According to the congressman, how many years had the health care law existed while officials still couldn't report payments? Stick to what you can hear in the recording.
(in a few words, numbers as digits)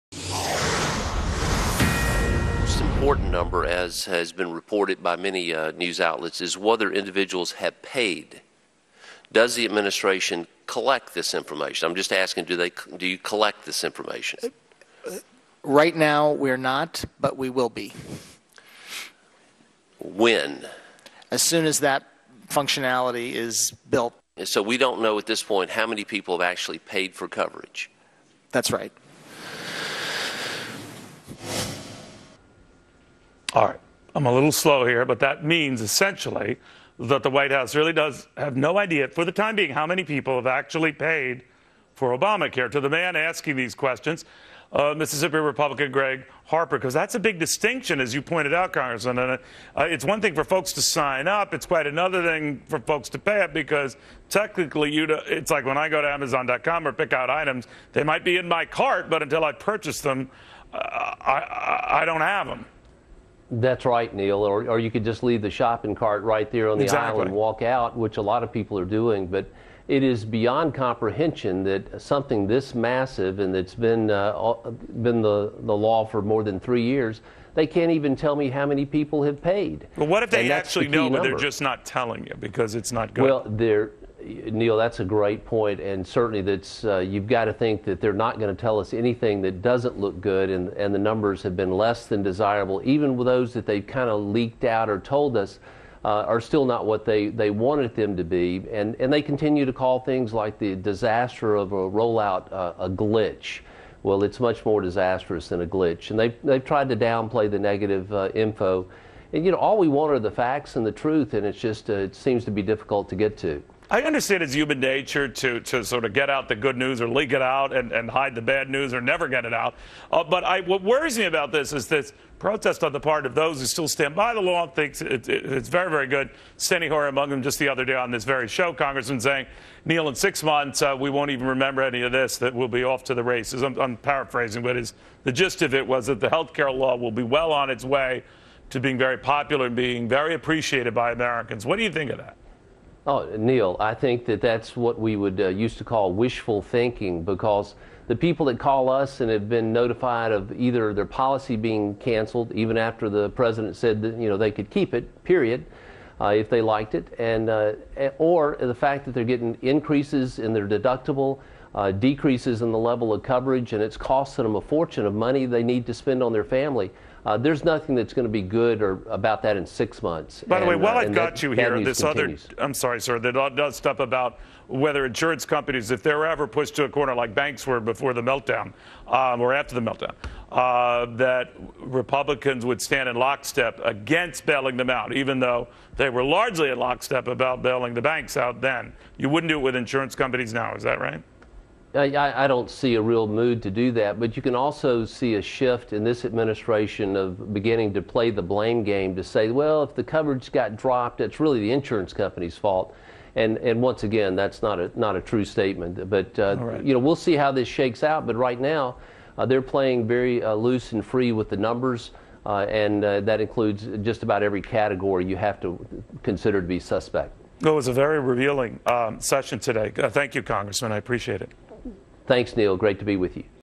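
3.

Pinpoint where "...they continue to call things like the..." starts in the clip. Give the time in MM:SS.
01:39.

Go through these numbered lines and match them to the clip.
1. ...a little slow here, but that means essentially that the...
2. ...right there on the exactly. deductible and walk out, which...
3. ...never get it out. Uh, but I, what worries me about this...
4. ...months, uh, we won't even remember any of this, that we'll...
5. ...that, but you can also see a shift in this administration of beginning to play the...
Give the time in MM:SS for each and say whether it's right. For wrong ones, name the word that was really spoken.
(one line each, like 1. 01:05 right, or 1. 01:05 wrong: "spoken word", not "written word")
1. 00:34 right
2. 01:06 wrong: "aisle", not "deductible"
3. 01:59 right
4. 02:10 right
5. 03:13 right.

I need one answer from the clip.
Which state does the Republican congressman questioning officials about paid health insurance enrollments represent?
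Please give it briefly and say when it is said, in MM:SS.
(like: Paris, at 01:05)
Mississippi, at 00:44.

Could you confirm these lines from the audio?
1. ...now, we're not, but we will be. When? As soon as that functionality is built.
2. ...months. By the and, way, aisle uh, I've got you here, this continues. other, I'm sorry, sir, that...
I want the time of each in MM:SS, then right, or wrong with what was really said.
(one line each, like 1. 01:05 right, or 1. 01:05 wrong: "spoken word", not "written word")
1. 00:15 right
2. 02:50 wrong: "while", not "aisle".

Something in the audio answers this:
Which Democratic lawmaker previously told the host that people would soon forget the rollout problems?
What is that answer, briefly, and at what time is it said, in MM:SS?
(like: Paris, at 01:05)
Steny Hoyer, at 02:06.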